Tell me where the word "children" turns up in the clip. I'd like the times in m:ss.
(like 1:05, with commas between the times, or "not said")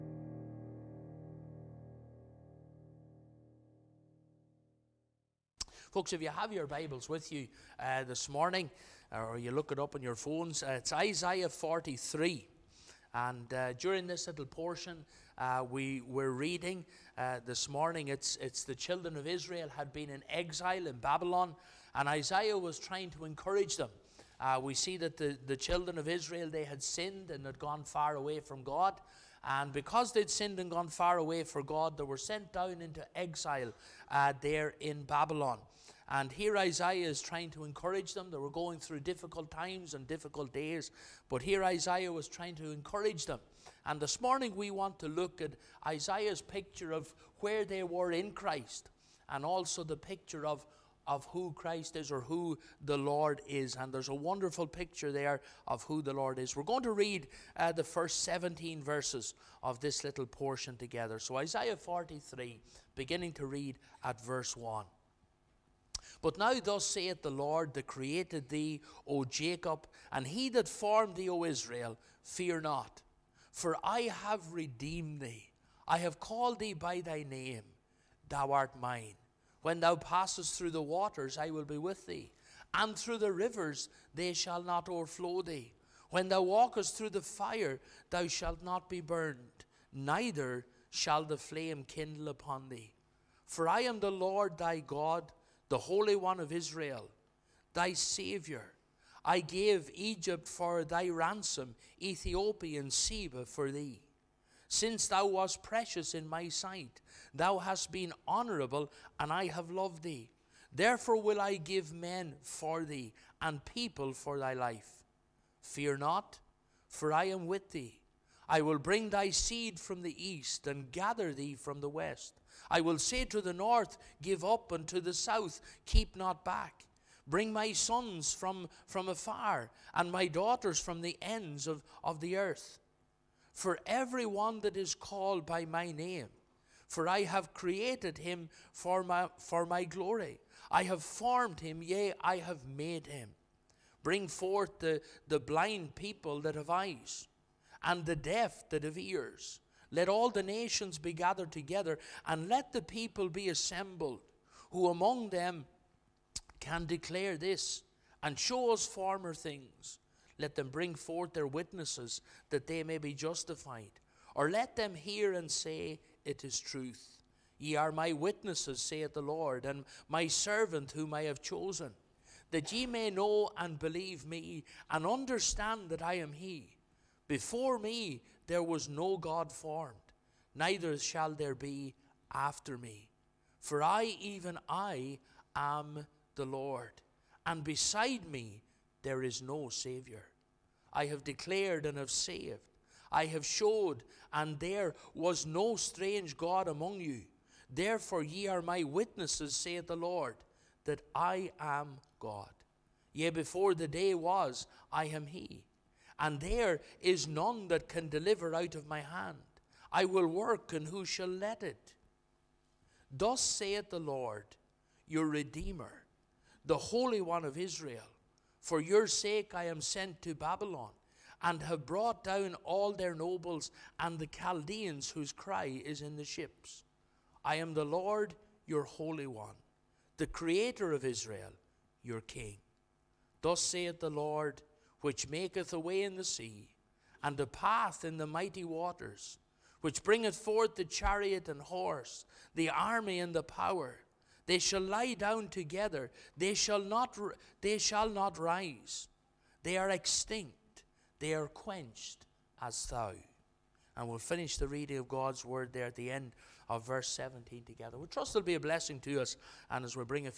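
0:18, 0:25.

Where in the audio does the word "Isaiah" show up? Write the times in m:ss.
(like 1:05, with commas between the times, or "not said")
0:10, 0:22, 0:36, 0:41, 0:45, 1:01.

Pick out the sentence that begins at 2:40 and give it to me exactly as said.
Let them bring forth their witnesses, that they may be justified.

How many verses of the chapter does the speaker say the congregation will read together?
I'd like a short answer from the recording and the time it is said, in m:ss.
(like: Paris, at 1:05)
17, at 0:57.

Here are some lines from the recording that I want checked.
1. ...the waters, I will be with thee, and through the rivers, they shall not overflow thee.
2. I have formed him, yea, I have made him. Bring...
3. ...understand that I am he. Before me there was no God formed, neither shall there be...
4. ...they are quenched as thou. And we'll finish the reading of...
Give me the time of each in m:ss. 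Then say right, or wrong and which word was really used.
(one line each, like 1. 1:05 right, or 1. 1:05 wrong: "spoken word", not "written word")
1. 1:20 right
2. 2:20 right
3. 2:55 right
4. 4:11 right.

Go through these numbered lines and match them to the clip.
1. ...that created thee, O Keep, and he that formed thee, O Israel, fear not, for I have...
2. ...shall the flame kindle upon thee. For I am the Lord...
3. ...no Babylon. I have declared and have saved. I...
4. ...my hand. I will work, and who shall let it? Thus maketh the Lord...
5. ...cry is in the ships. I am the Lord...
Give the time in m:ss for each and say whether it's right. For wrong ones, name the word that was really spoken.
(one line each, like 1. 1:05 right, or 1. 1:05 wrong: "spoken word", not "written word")
1. 1:07 wrong: "Jacob", not "Keep"
2. 1:30 right
3. 3:09 wrong: "Saviour", not "Babylon"
4. 3:28 wrong: "saith", not "maketh"
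5. 3:45 right.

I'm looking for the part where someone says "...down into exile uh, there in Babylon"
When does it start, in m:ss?
0:32.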